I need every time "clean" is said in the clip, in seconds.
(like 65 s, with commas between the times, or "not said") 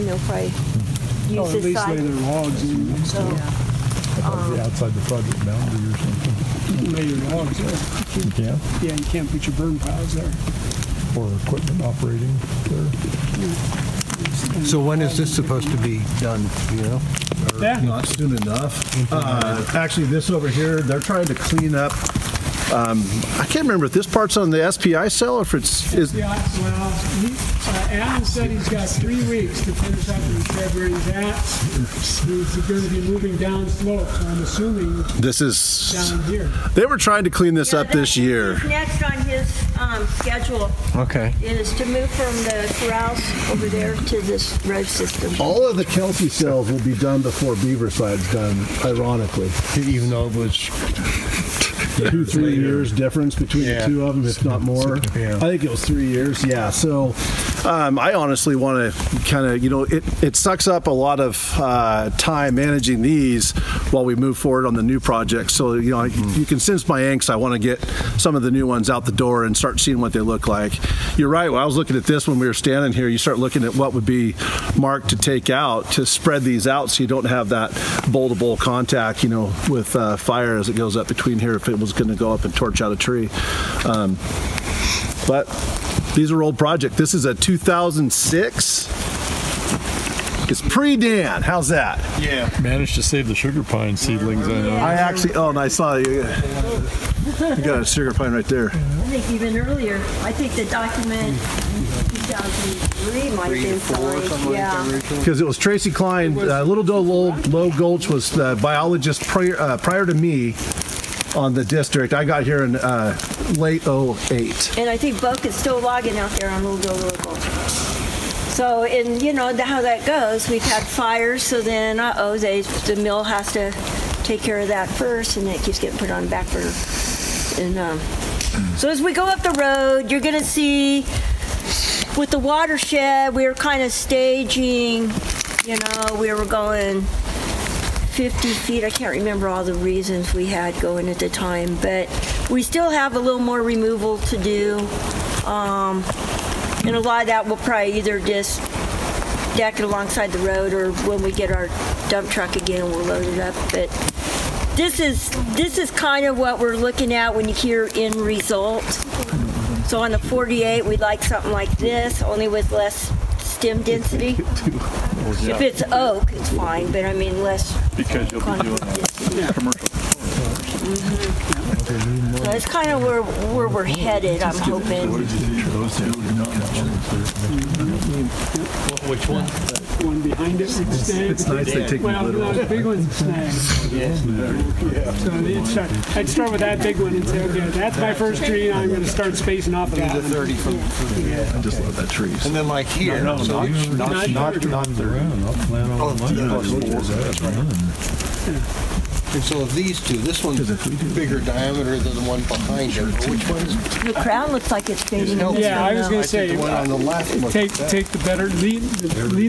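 21 s, 37 s.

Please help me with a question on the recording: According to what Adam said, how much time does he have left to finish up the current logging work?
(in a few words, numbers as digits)
3 weeks.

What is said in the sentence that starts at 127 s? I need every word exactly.
And um, so as we go up the road, you're gonna see with the watershed, we are kind of staging.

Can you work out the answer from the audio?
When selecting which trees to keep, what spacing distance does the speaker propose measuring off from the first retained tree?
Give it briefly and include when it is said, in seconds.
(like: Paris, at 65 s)
30 feet, at 190 s.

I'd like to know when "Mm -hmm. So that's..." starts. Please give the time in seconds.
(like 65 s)
170 s.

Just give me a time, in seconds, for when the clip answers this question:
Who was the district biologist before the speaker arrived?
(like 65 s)
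105 s.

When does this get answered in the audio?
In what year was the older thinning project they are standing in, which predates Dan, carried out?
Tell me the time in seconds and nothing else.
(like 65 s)
87 s.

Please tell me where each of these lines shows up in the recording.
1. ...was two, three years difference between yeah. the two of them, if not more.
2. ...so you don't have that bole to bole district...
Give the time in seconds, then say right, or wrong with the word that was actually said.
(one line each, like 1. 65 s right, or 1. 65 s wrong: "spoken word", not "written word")
1. 50 s right
2. 76 s wrong: "contact", not "district".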